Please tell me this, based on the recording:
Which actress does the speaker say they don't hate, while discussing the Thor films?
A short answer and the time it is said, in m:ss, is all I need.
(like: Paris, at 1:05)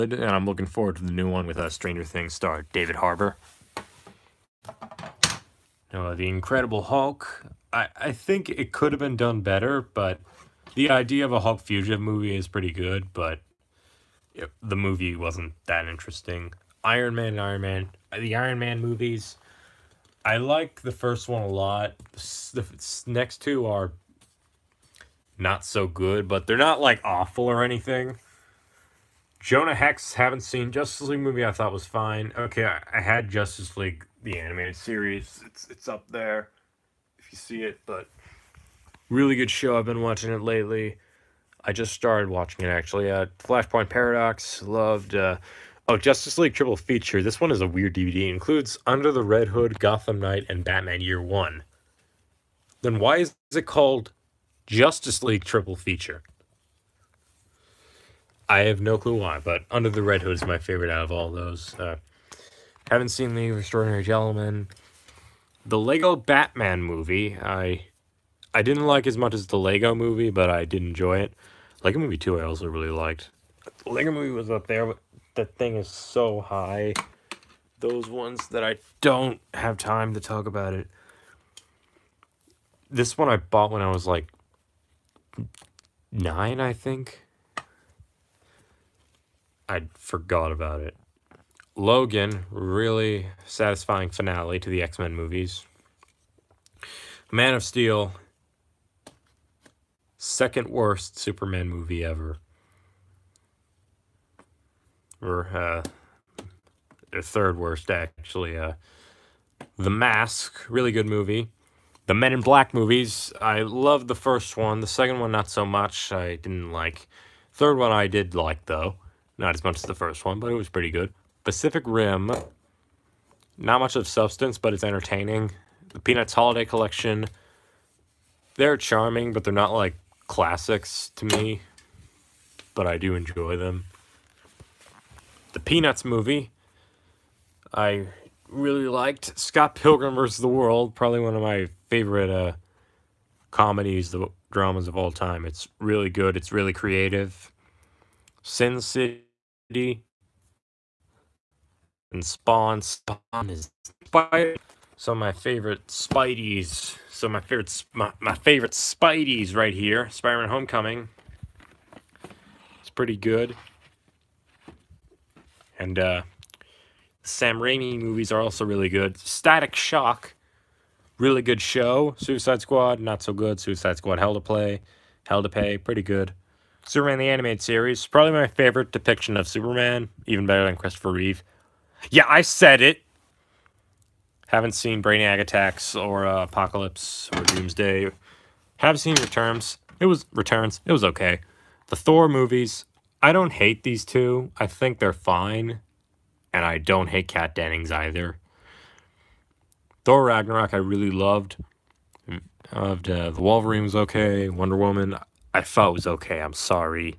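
Kat Dennings, at 3:17.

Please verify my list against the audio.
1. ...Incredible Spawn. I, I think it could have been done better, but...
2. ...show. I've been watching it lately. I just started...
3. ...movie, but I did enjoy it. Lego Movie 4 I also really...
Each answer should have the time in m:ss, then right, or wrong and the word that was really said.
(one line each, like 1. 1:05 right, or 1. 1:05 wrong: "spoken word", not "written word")
1. 0:06 wrong: "Hulk", not "Spawn"
2. 0:39 right
3. 1:09 wrong: "2", not "4".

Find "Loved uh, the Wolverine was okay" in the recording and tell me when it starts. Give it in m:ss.
3:22.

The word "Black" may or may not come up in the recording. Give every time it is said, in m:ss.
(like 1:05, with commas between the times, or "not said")
1:52.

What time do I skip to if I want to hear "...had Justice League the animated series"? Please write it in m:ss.
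0:33.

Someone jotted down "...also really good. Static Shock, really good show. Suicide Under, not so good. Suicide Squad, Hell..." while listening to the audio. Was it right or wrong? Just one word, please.
wrong.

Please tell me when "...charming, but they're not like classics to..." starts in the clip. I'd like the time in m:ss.
2:08.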